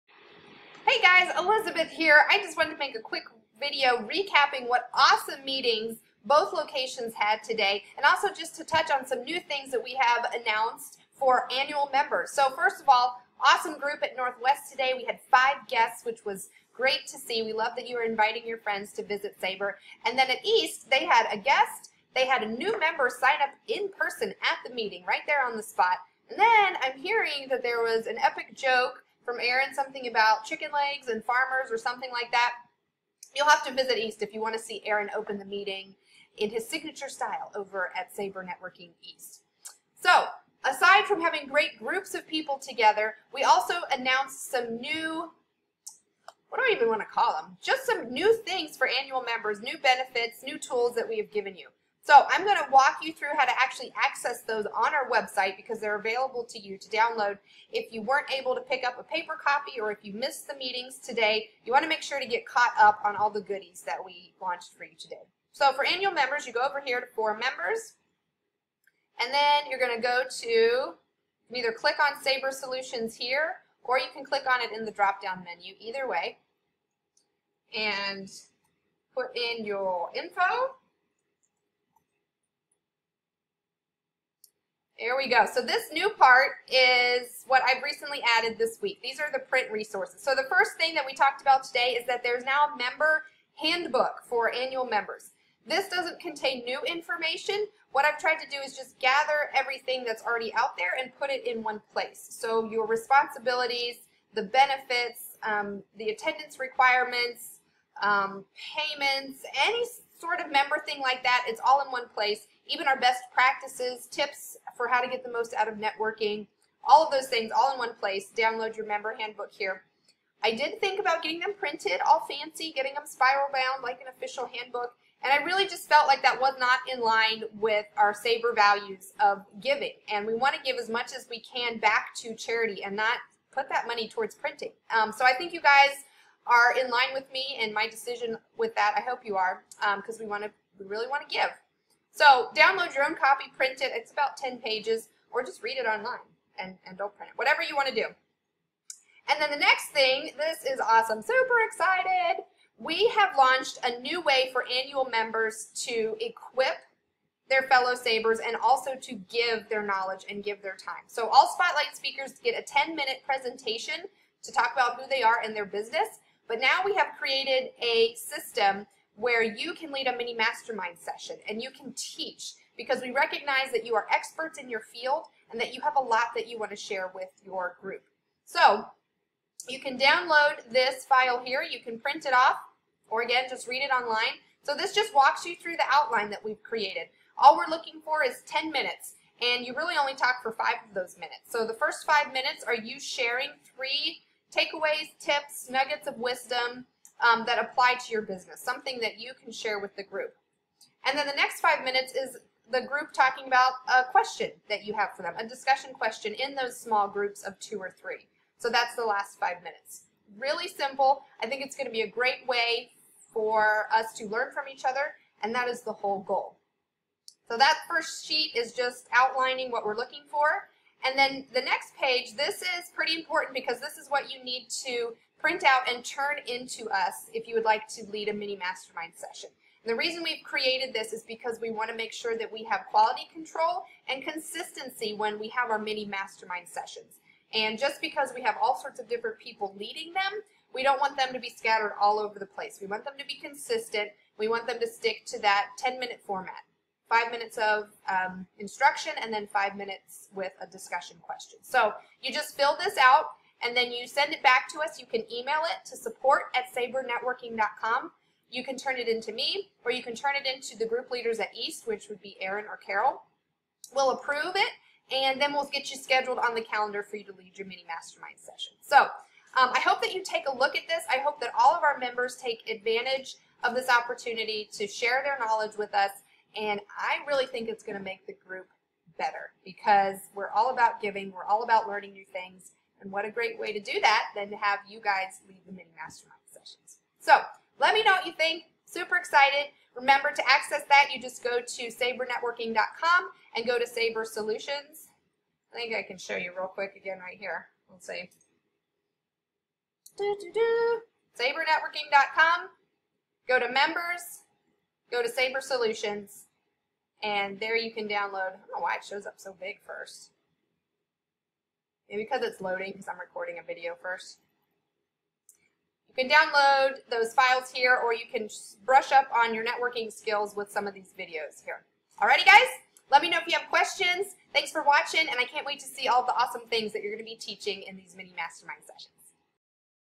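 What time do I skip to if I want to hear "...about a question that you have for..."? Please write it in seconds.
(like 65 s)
203 s.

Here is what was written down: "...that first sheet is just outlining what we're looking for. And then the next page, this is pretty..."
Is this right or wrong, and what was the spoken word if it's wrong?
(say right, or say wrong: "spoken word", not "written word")
right.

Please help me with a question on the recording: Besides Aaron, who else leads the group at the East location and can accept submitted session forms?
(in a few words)
Carol.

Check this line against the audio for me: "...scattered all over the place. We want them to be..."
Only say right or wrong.
right.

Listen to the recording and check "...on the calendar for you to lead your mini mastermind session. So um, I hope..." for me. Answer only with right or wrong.
right.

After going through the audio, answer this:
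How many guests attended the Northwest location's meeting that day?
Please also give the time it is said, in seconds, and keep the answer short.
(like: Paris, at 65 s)
5, at 15 s.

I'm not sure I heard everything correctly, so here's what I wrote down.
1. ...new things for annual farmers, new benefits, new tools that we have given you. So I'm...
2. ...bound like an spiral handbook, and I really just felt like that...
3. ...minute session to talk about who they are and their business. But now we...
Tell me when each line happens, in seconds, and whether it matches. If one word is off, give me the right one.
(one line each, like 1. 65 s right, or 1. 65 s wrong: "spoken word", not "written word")
1. 48 s wrong: "members", not "farmers"
2. 123 s wrong: "official", not "spiral"
3. 162 s wrong: "presentation", not "session".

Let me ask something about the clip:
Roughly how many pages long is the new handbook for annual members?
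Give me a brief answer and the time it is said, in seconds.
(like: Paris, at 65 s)
10, at 144 s.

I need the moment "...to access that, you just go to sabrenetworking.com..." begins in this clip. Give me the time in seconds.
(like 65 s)
290 s.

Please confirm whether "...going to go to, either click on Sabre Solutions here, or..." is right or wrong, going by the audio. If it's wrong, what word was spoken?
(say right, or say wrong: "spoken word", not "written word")
right.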